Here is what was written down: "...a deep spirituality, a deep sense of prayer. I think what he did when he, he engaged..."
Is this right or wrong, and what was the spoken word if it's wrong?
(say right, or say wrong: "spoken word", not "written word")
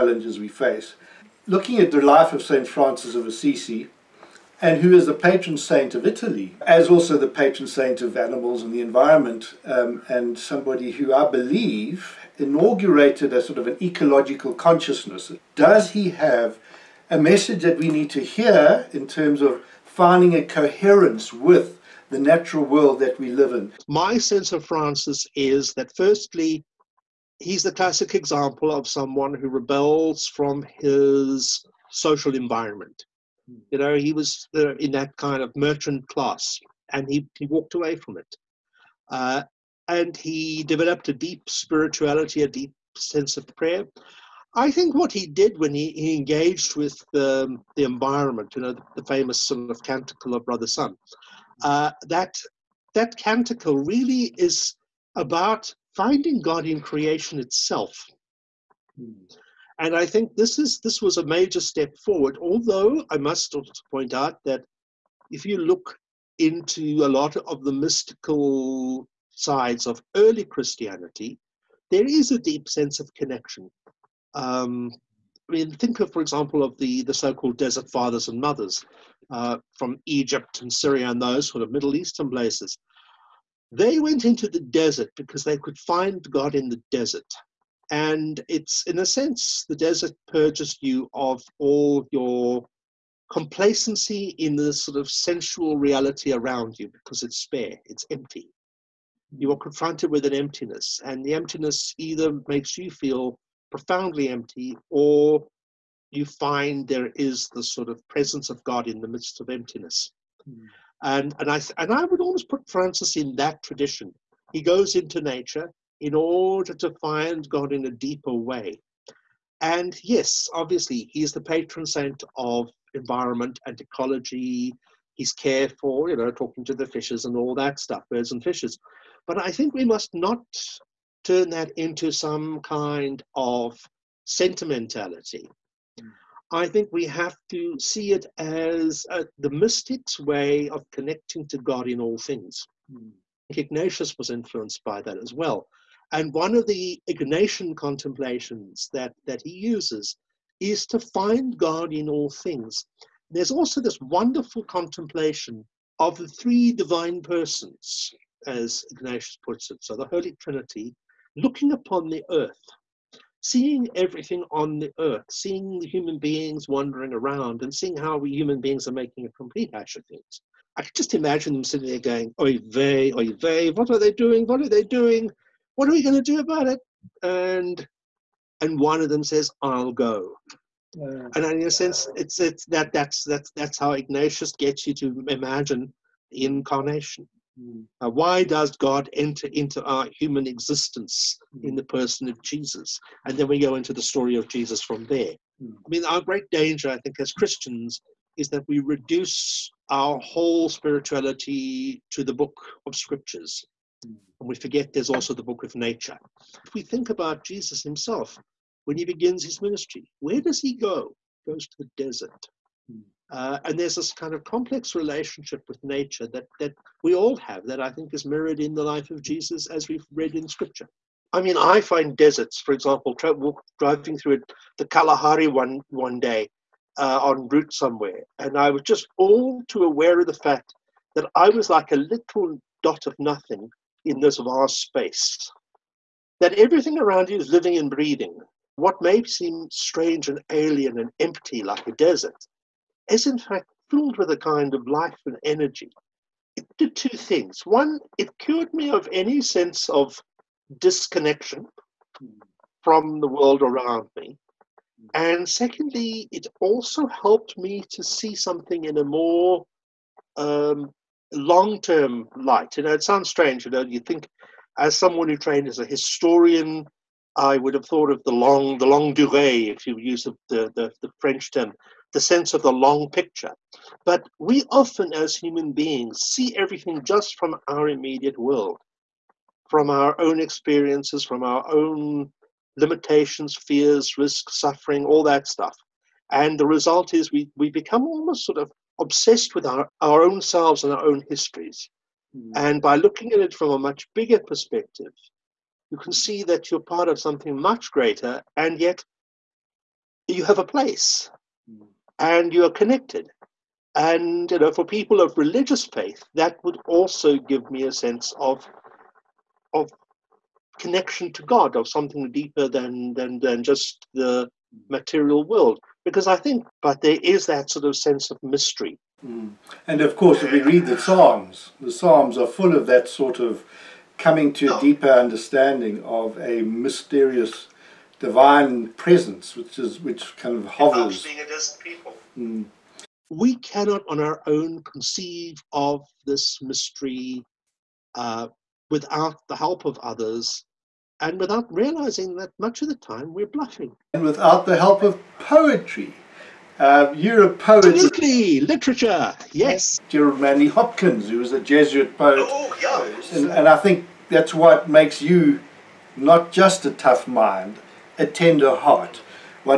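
right.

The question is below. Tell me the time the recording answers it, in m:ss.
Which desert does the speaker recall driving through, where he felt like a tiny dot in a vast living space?
3:44.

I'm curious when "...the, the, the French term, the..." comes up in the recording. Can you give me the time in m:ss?
4:30.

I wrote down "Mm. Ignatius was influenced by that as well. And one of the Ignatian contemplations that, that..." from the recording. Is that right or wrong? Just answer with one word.
right.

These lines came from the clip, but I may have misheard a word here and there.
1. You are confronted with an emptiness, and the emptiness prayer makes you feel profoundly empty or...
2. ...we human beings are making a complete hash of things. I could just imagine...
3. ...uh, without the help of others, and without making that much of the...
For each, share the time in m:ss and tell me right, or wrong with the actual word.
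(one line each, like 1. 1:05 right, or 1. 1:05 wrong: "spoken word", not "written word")
1. 1:39 wrong: "either", not "prayer"
2. 2:48 right
3. 5:38 wrong: "realizing", not "making".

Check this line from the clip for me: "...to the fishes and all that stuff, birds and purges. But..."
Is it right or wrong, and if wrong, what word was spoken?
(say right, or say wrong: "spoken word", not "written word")
wrong: "fishes", not "purges".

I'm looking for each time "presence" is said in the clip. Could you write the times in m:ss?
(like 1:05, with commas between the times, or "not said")
1:48, 5:28.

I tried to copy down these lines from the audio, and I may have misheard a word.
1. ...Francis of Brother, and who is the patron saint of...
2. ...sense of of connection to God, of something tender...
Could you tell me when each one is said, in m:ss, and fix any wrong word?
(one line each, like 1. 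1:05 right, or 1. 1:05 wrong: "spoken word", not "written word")
1. 0:02 wrong: "Assisi", not "Brother"
2. 5:07 wrong: "deeper", not "tender".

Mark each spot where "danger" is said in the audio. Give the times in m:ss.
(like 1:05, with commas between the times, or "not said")
3:16.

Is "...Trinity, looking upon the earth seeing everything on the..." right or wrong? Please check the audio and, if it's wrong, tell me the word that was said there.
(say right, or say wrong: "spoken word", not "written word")
right.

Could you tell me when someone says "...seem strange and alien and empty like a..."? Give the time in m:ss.
3:59.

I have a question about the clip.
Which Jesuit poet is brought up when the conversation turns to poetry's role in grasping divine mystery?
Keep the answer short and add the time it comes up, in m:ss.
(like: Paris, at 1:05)
Gerald Manley Hopkins, at 5:50.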